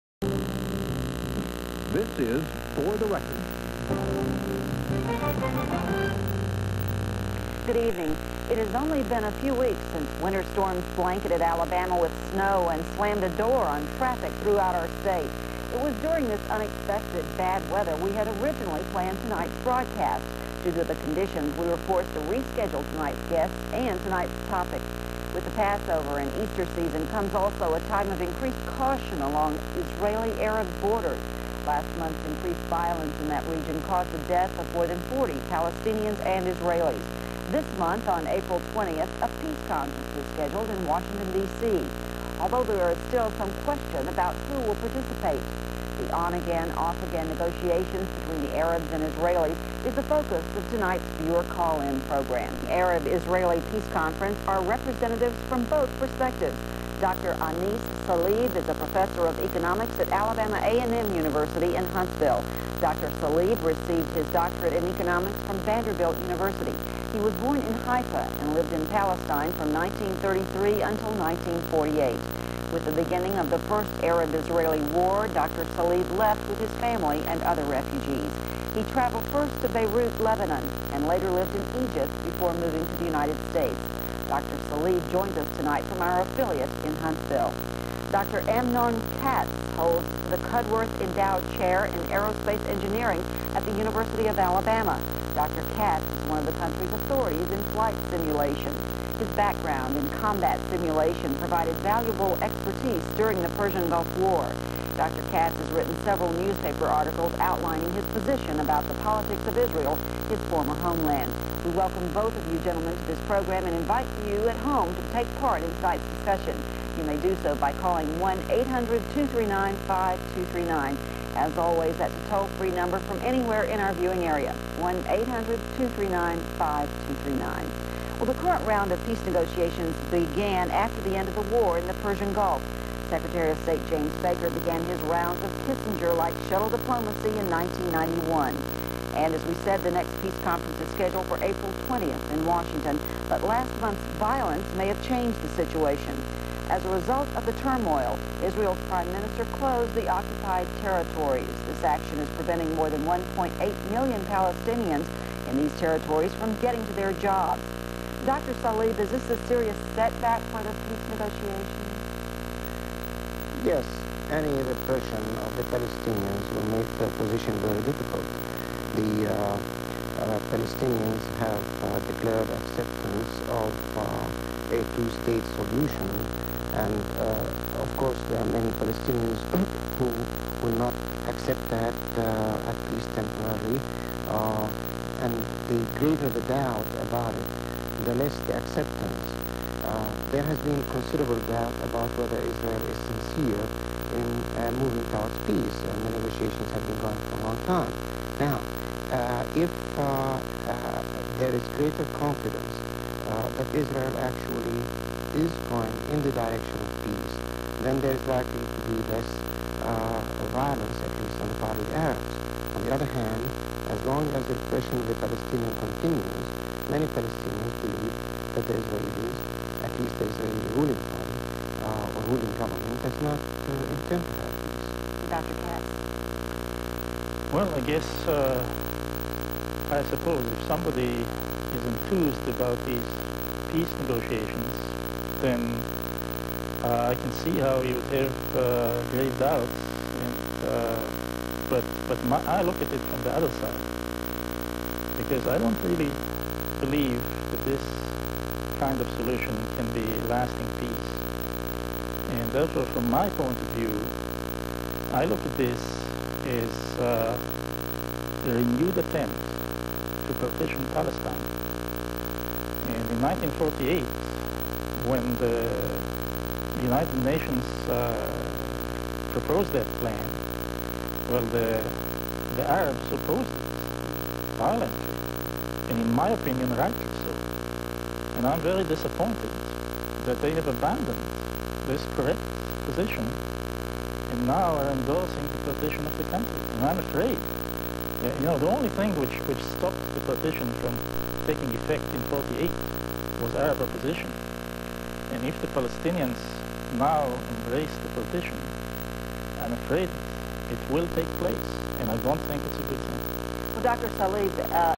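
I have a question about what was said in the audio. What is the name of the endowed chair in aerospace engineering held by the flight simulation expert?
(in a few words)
Cudworth Endowed Chair.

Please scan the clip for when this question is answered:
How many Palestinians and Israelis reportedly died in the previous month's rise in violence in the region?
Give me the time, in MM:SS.
00:34.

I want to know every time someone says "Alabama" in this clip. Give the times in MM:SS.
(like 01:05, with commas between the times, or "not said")
00:11, 01:00, 01:34.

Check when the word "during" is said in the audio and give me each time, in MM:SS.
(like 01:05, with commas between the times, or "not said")
00:15, 01:43.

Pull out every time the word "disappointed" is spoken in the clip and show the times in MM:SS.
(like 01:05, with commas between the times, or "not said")
04:38.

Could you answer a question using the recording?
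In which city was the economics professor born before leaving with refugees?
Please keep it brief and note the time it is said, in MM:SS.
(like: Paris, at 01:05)
Haifa, at 01:07.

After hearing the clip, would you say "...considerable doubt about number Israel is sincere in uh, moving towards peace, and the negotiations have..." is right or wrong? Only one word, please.
wrong.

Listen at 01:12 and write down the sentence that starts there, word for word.
With the beginning of the first Arab-Israeli war, Dr.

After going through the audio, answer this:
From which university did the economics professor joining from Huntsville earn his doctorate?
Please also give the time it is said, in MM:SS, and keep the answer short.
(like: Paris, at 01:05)
Vanderbilt University, at 01:05.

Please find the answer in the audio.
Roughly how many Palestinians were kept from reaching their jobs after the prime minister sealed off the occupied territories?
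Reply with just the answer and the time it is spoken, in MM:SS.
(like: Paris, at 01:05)
1.8 million, at 02:33.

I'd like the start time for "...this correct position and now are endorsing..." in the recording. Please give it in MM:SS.
04:41.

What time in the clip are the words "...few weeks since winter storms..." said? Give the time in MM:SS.
00:09.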